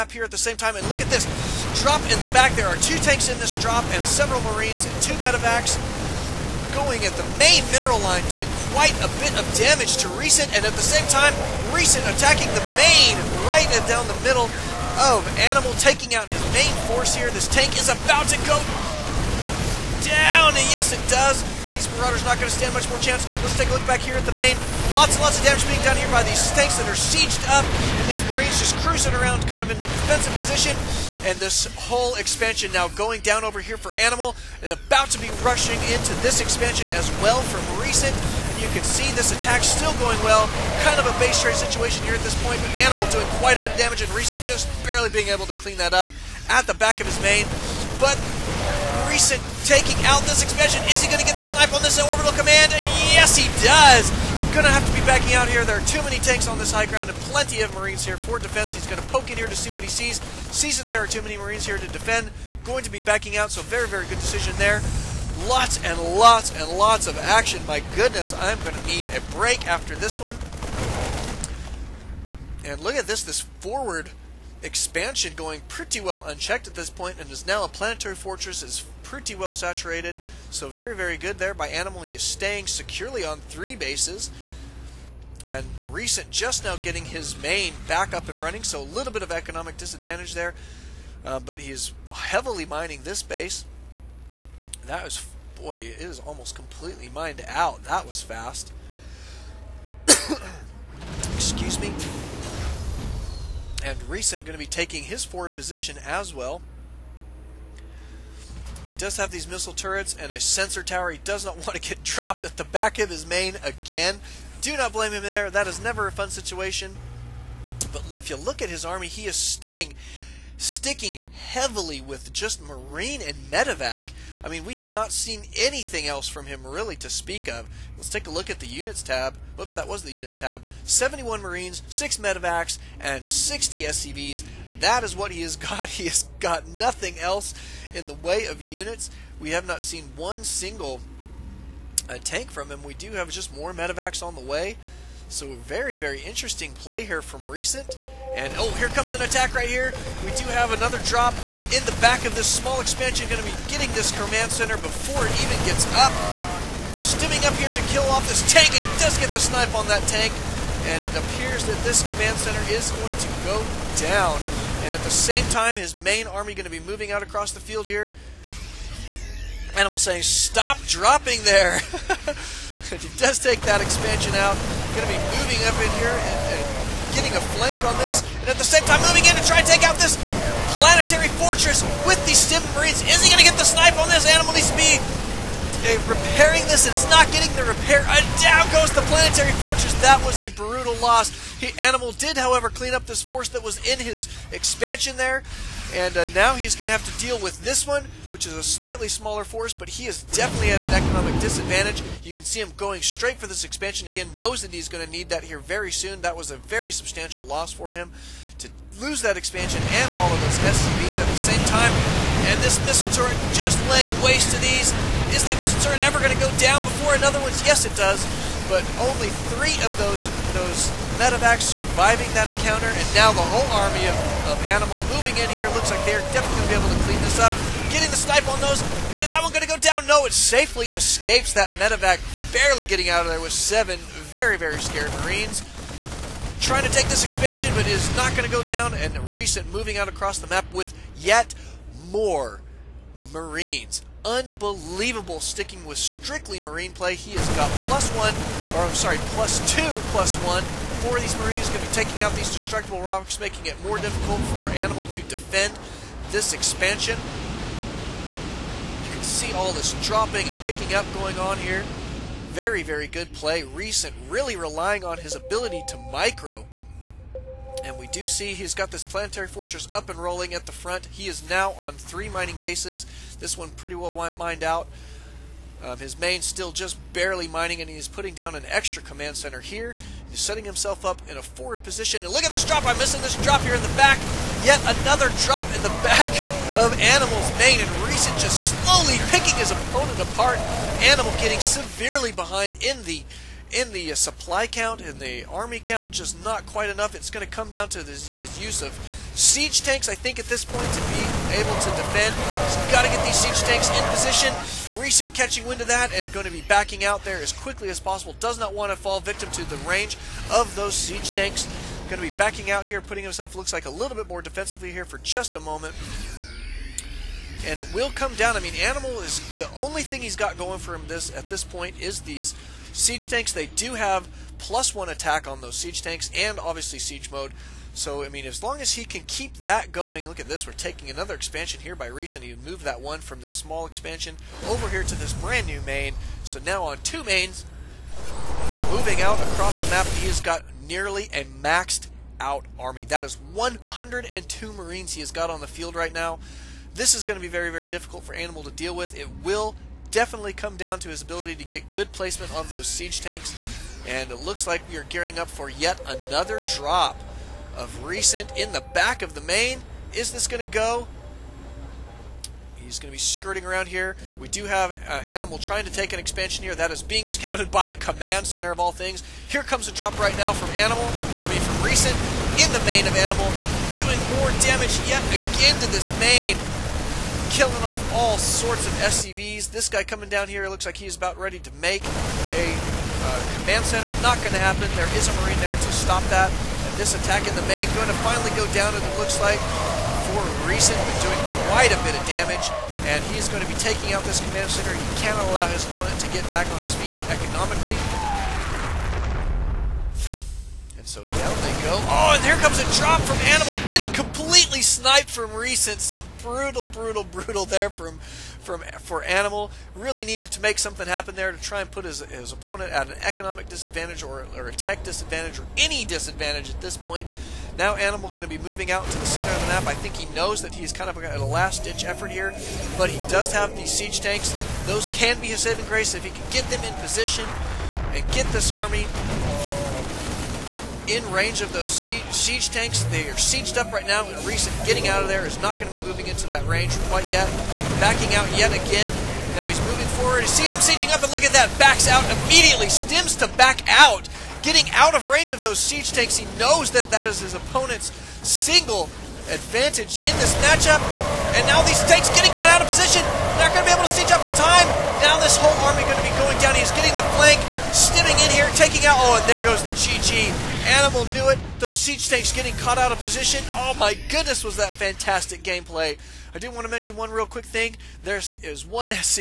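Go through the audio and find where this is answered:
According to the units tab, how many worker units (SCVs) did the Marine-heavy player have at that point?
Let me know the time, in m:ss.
2:13.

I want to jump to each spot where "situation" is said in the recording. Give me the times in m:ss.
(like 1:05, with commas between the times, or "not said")
0:41, 1:56.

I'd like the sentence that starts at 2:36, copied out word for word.
Stimming up here to kill off this tank, and he does get the snipe on that tank.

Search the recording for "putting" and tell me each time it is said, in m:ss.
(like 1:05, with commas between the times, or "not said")
4:38, 5:12.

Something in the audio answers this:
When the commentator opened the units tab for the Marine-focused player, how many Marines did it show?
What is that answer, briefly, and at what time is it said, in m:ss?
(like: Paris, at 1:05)
71, at 2:10.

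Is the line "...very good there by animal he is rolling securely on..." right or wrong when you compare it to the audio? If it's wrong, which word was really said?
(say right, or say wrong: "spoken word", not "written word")
wrong: "staying", not "rolling".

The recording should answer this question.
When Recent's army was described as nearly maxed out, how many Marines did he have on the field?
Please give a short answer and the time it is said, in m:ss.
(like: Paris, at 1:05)
102, at 5:43.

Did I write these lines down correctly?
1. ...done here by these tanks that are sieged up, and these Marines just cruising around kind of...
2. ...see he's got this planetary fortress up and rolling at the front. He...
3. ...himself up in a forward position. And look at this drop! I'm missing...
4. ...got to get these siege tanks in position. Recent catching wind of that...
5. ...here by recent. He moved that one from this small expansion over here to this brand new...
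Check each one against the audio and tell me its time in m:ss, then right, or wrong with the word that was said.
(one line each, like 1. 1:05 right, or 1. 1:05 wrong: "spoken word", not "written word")
1. 0:25 right
2. 4:28 right
3. 4:40 right
4. 5:02 right
5. 5:31 right.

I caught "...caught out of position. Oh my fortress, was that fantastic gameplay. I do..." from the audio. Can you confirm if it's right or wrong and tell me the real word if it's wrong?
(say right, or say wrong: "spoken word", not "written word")
wrong: "goodness", not "fortress".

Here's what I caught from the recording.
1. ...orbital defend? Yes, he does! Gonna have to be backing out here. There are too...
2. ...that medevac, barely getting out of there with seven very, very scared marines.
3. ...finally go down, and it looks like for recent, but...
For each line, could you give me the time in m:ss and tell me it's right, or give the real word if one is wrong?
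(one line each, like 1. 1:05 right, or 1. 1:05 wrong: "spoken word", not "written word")
1. 0:52 wrong: "command", not "defend"
2. 3:51 right
3. 6:28 right.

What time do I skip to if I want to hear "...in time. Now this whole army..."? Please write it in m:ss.
7:34.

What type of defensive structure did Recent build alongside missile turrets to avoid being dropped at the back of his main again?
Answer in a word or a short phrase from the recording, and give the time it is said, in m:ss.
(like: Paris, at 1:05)
Sensor tower, at 1:50.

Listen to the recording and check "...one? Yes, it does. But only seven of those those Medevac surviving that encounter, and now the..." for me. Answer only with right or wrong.
wrong.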